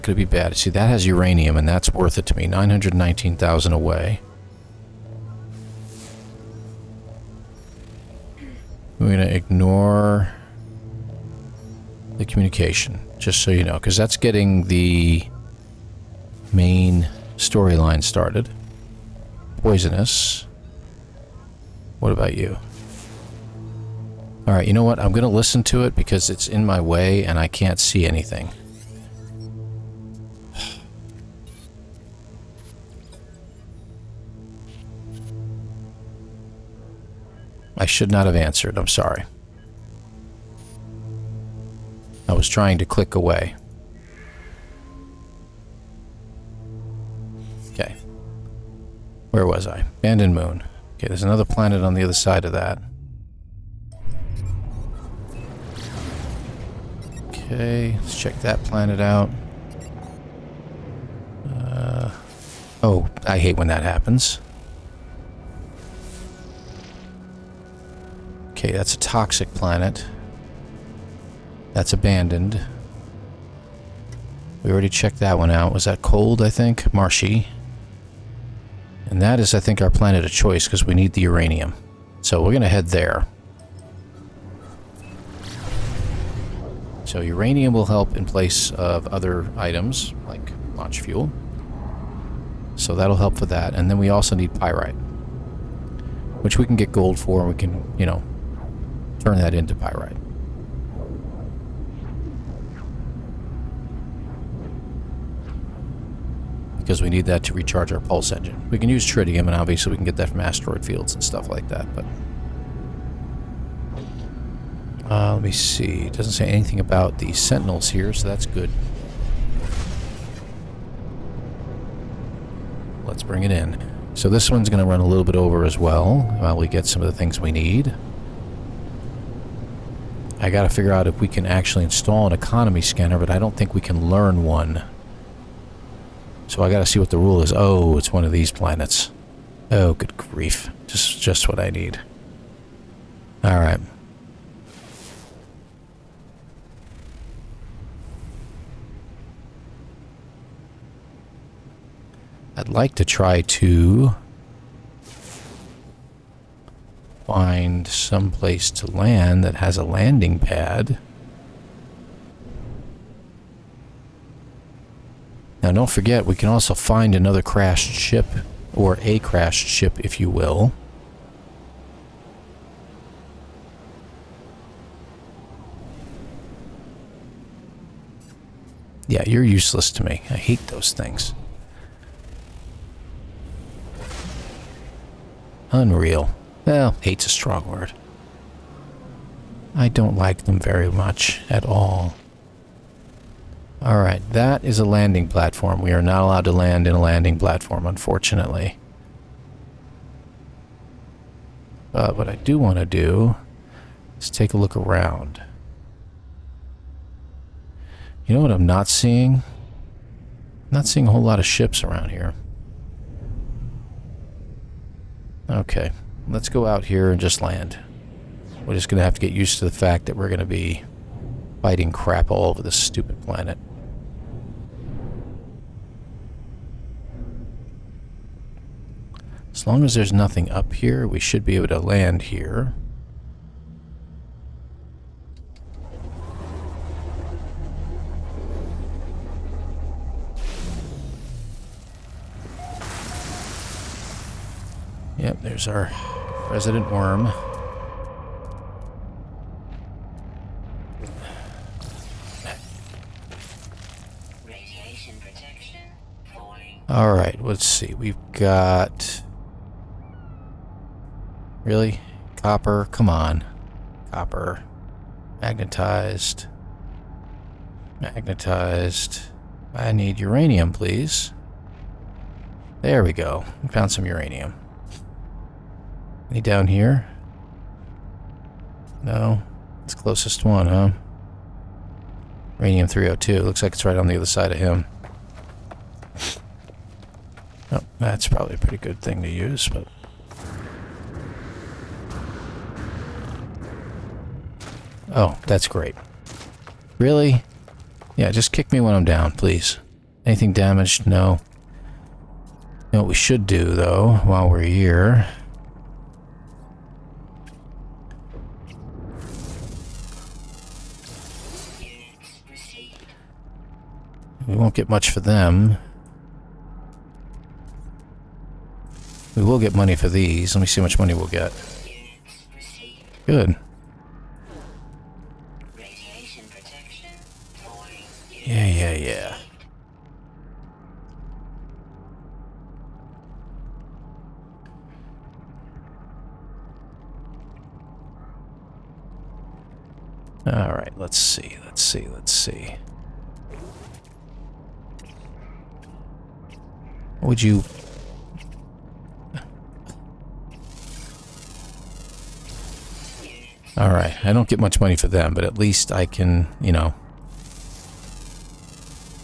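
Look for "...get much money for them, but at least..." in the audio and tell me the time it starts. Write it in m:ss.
5:54.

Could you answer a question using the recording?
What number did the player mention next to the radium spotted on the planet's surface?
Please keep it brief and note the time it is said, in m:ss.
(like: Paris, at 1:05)
302, at 4:42.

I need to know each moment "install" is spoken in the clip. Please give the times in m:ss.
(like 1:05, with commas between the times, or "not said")
2:11.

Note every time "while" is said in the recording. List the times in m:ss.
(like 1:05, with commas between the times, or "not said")
2:06, 5:04.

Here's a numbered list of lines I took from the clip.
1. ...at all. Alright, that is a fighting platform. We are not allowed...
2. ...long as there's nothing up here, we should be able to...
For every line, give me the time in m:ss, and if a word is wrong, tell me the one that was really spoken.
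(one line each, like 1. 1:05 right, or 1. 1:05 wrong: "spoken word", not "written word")
1. 3:11 wrong: "landing", not "fighting"
2. 3:49 right.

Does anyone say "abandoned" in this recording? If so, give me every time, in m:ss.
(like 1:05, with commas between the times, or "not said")
0:49, 1:11.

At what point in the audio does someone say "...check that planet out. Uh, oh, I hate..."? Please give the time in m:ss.
0:58.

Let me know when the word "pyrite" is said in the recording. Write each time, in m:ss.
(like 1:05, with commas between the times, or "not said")
1:34, 1:39.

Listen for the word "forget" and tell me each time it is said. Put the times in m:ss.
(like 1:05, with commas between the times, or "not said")
2:45.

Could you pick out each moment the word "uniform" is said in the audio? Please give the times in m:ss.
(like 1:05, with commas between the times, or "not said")
not said.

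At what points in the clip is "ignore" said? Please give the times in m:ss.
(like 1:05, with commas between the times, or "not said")
0:09.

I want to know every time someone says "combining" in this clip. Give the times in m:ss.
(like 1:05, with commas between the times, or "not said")
not said.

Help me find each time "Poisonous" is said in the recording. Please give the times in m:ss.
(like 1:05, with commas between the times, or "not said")
0:19.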